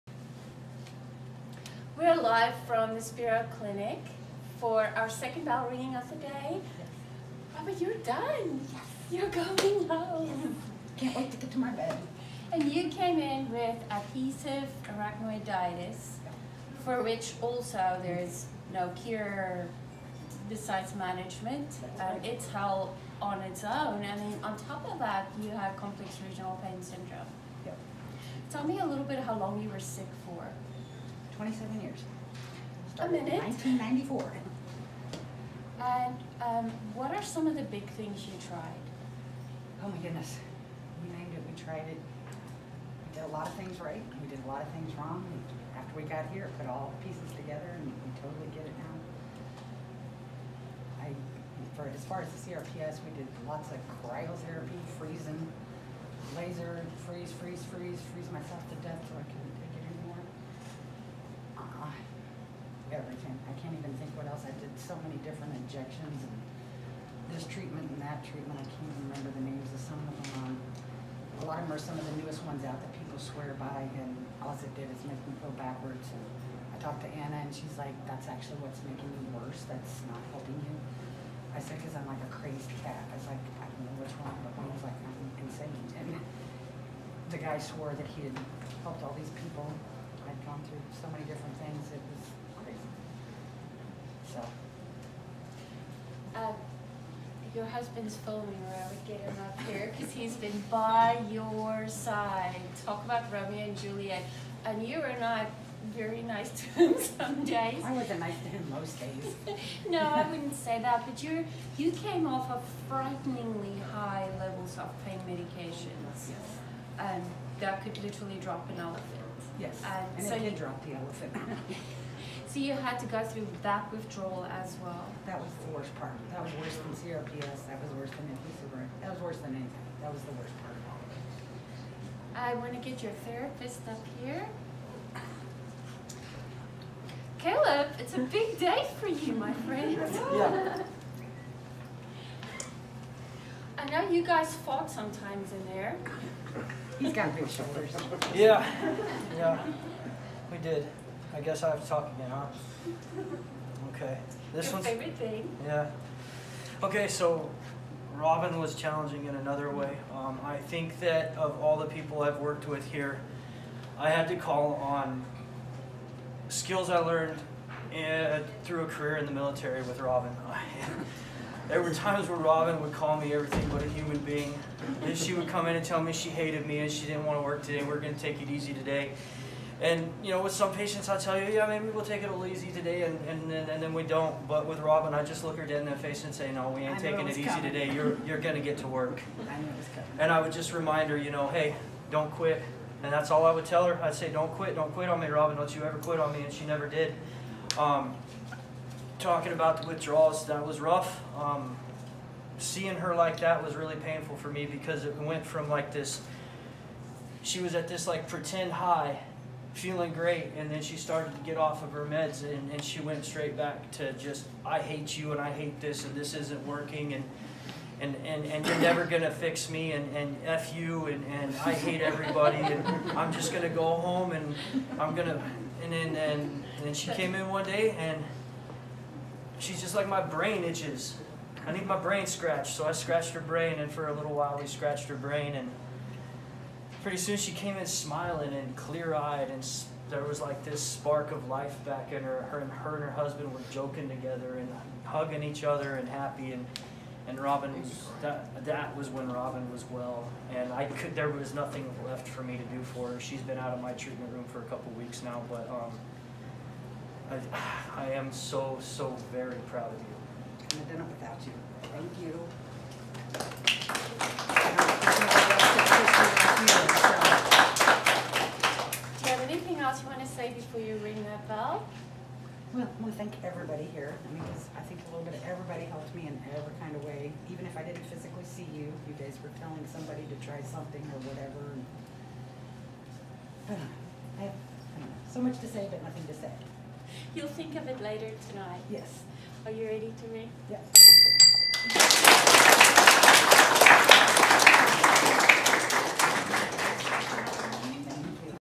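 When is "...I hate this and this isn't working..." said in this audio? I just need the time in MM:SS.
03:35.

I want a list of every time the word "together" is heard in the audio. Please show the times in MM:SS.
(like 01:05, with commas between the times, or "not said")
00:47, 04:04.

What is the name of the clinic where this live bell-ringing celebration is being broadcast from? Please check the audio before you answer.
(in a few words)
Spero Clinic.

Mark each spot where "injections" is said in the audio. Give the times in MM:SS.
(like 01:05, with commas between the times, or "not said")
01:05.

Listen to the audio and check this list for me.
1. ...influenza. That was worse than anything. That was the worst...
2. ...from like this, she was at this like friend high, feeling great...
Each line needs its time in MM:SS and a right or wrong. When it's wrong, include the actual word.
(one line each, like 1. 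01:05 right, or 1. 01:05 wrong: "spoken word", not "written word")
1. 02:08 right
2. 03:25 wrong: "pretend", not "friend".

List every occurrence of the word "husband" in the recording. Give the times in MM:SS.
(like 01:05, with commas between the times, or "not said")
01:37, 04:03.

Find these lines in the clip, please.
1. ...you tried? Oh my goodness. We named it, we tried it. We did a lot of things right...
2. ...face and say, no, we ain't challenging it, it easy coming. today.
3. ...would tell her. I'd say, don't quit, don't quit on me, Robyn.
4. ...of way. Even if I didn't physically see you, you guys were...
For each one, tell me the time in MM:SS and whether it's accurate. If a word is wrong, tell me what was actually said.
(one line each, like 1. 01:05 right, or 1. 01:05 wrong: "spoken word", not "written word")
1. 00:38 right
2. 03:05 wrong: "taking", not "challenging"
3. 03:13 right
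4. 04:36 right.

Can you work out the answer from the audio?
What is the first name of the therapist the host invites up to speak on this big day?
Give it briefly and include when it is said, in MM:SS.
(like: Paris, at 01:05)
Caleb, at 02:17.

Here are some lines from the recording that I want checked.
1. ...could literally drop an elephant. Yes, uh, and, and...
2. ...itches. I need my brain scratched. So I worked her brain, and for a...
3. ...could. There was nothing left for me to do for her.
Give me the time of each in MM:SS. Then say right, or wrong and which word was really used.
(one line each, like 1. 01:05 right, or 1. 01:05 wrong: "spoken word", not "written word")
1. 01:57 right
2. 03:50 wrong: "scratched", not "worked"
3. 04:10 right.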